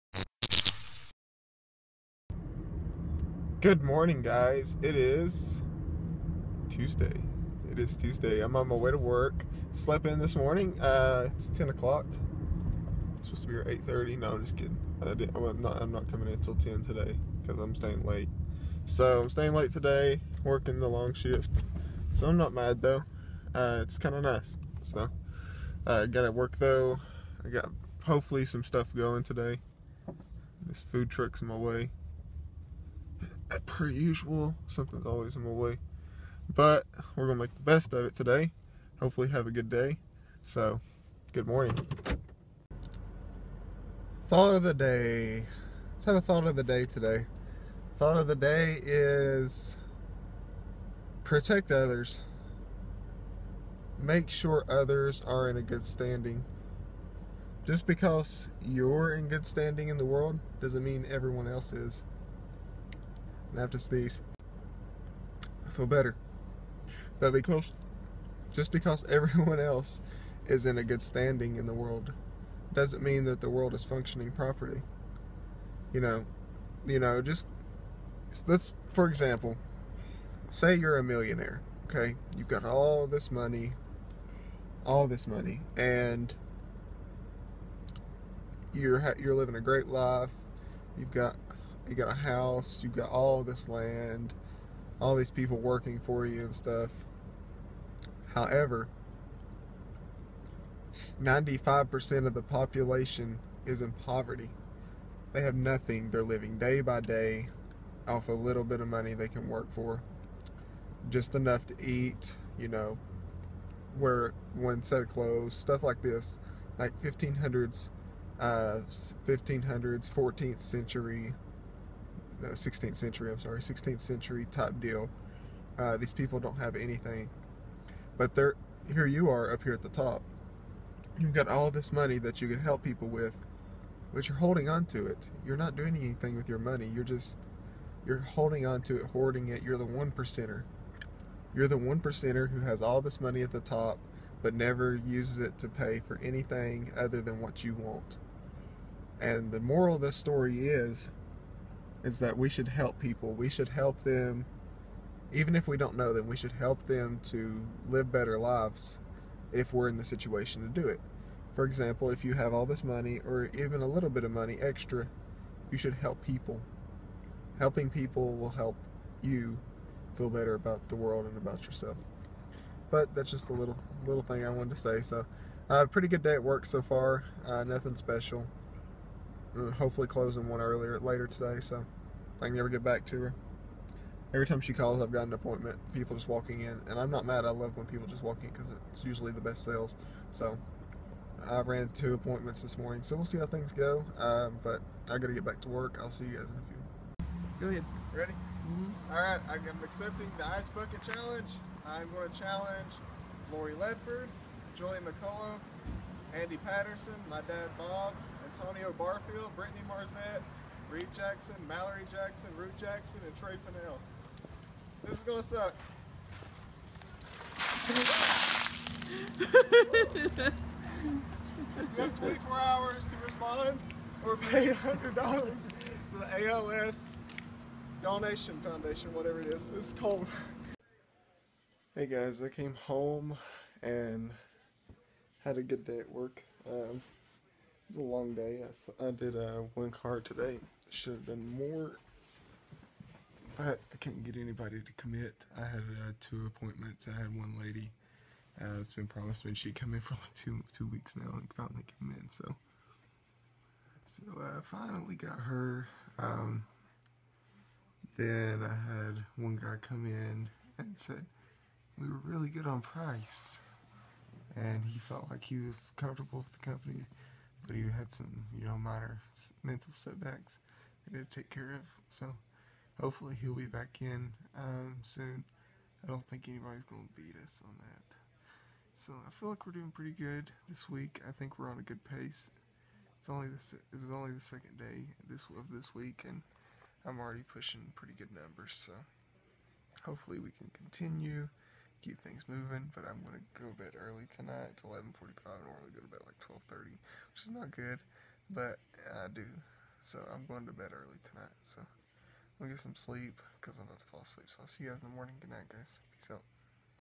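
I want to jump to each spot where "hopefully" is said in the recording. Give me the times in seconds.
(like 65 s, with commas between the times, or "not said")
28 s, 38 s, 179 s, 272 s, 290 s.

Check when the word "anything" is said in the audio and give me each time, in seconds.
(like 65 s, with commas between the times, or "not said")
126 s, 135 s, 146 s.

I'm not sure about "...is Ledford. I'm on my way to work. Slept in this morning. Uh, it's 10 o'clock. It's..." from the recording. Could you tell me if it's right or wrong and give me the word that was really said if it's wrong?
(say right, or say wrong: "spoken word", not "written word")
wrong: "Tuesday", not "Ledford".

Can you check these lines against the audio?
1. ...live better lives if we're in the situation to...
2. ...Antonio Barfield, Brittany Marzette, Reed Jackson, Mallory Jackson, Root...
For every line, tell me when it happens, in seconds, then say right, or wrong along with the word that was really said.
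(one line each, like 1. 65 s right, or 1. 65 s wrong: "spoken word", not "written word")
1. 157 s right
2. 208 s right.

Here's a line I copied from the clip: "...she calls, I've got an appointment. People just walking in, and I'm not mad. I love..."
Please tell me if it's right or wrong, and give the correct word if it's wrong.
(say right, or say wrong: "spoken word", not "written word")
right.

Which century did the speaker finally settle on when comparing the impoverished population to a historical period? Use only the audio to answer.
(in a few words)
16th century.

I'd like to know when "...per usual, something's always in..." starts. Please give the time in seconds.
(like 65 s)
33 s.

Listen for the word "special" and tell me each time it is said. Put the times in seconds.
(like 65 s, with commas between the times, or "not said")
177 s.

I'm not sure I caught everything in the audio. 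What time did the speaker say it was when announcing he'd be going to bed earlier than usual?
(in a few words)
11:45.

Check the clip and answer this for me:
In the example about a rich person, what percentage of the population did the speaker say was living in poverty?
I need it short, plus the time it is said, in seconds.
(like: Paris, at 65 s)
95%, at 101 s.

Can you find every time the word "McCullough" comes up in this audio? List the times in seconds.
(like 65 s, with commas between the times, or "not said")
204 s.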